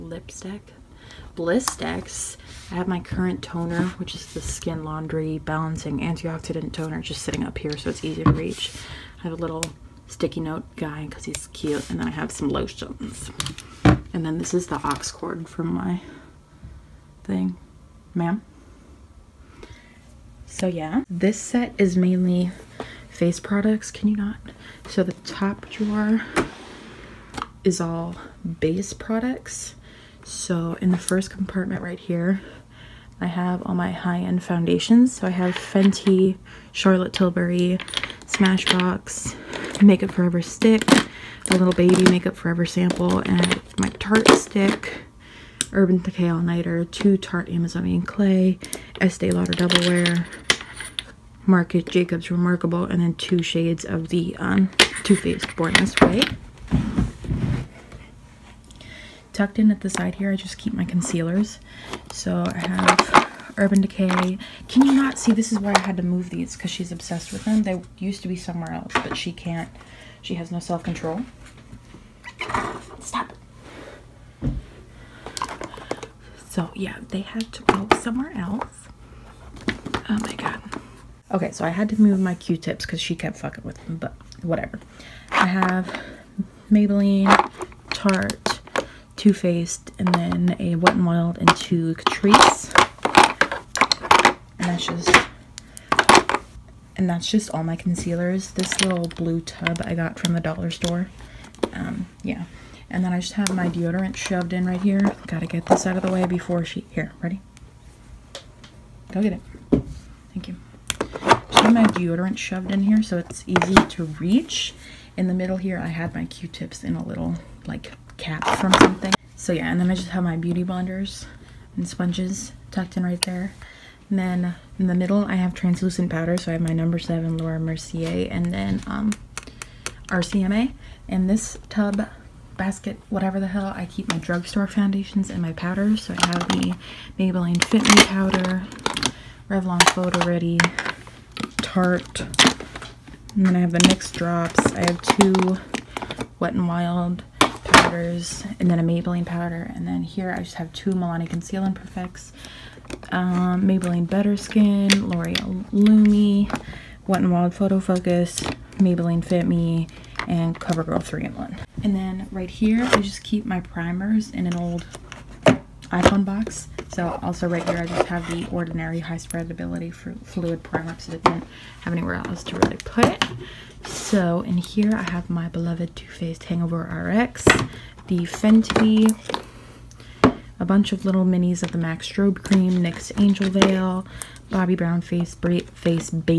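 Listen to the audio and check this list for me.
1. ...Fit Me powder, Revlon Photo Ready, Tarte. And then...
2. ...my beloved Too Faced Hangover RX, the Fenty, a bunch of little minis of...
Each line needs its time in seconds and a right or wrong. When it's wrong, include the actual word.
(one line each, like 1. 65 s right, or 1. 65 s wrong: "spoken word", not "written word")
1. 137 s right
2. 175 s right.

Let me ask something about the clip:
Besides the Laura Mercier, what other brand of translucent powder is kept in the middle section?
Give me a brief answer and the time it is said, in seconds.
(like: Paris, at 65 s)
RCMA, at 130 s.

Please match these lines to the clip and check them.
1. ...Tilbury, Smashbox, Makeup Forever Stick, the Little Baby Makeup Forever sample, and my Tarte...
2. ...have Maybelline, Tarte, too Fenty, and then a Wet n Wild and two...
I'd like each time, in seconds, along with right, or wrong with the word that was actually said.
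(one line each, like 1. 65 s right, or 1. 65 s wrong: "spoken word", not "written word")
1. 37 s right
2. 85 s wrong: "Faced", not "Fenty".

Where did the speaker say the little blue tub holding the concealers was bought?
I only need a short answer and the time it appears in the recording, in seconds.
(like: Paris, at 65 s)
the dollar store, at 100 s.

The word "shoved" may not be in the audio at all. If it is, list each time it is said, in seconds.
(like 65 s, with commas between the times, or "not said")
104 s, 112 s.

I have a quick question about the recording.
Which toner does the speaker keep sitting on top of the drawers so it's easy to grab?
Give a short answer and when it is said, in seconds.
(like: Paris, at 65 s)
Skin Laundry Balancing Antioxidant Toner, at 4 s.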